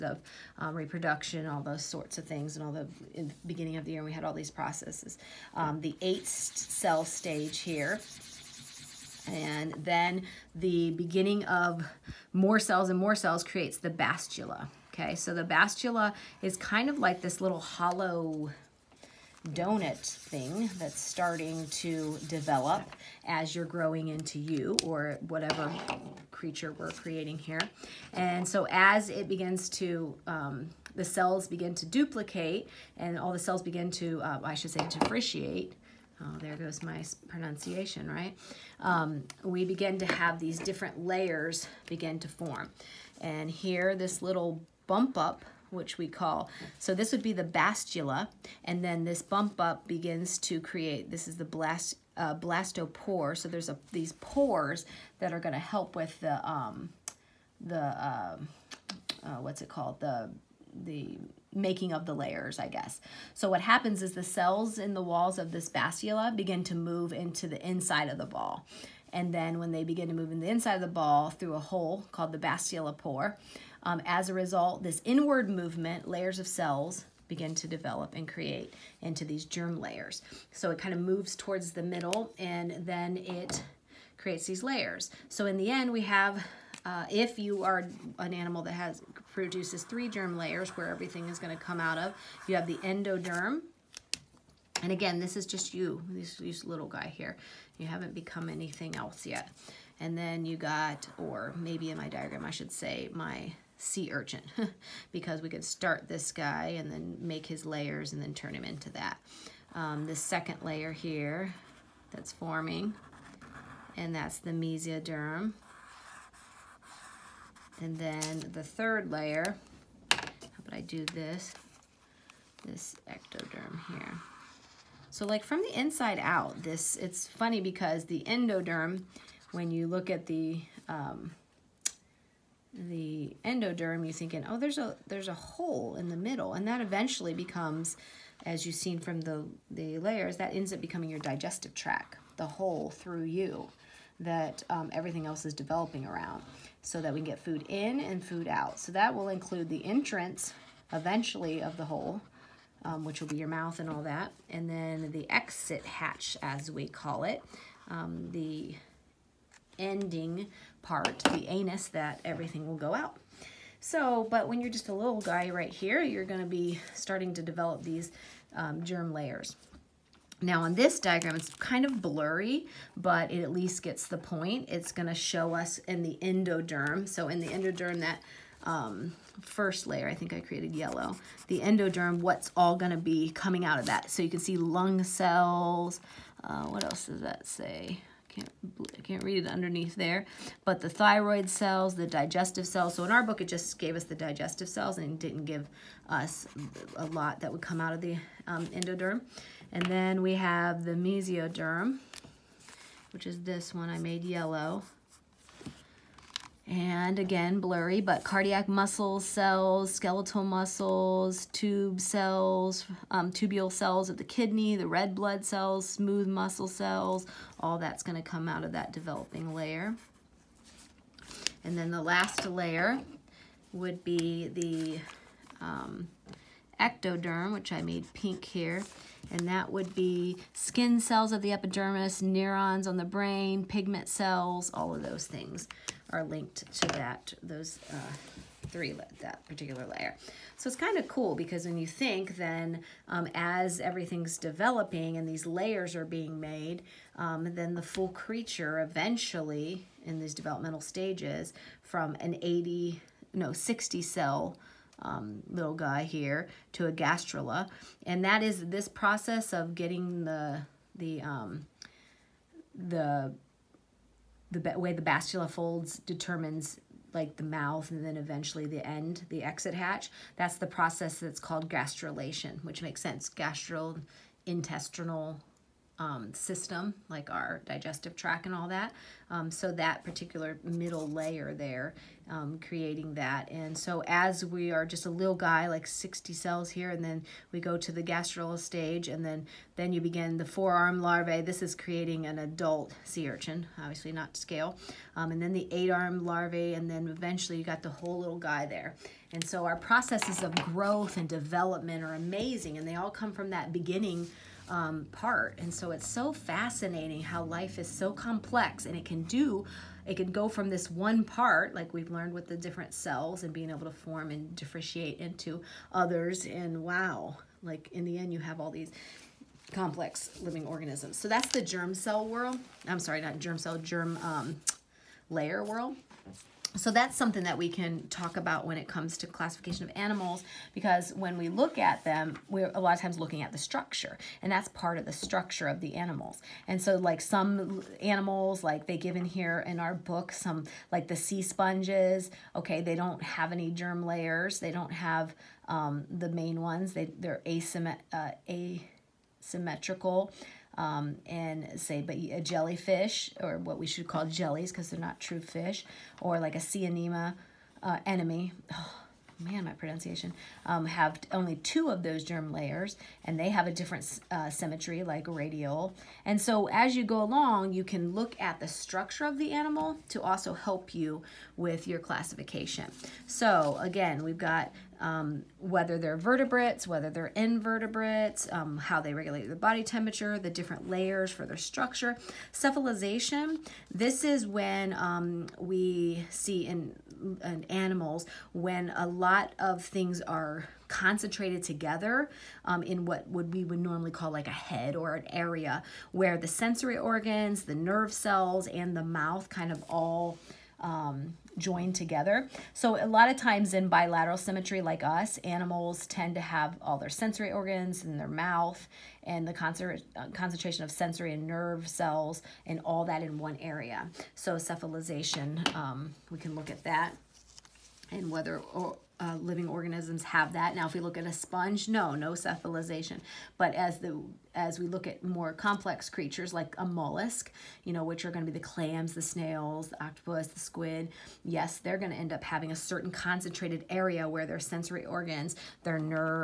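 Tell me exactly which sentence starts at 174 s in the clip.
It's gonna show us in the endoderm.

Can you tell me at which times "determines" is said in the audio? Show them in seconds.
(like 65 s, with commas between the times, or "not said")
265 s.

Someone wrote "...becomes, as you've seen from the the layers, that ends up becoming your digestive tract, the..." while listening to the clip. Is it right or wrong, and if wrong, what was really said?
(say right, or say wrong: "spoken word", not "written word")
right.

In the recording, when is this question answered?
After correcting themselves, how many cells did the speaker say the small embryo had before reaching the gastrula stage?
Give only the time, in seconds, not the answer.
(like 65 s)
253 s.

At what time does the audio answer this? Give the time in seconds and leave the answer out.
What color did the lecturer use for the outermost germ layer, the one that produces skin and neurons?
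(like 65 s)
228 s.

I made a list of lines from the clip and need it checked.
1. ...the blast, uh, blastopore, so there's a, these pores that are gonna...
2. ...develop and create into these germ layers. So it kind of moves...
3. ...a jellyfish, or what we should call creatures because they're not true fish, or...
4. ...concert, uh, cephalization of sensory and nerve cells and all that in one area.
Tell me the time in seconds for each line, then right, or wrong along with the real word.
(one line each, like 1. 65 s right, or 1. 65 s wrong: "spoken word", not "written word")
1. 51 s right
2. 77 s right
3. 352 s wrong: "jellies", not "creatures"
4. 409 s wrong: "concentration", not "cephalization".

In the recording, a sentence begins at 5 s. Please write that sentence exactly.
Um, the eight cell stage here, and then the beginning of more cells and more cells creates the blastula.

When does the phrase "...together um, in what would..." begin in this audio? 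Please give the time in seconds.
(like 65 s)
391 s.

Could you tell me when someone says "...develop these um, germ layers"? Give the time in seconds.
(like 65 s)
167 s.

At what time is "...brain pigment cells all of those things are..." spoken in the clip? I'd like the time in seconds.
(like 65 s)
233 s.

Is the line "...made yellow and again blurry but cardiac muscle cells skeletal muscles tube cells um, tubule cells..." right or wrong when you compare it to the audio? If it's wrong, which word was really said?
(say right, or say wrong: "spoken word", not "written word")
right.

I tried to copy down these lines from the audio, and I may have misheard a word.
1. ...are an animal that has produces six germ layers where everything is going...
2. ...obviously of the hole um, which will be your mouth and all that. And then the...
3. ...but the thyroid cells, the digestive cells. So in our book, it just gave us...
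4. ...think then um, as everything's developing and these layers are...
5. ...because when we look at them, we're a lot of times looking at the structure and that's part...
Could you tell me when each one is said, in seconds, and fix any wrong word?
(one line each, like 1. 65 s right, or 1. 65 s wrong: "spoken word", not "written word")
1. 87 s wrong: "three", not "six"
2. 150 s wrong: "eventually", not "obviously"
3. 190 s right
4. 241 s right
5. 330 s right.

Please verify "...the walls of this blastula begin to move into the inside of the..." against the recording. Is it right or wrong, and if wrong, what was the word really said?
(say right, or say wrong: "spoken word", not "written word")
right.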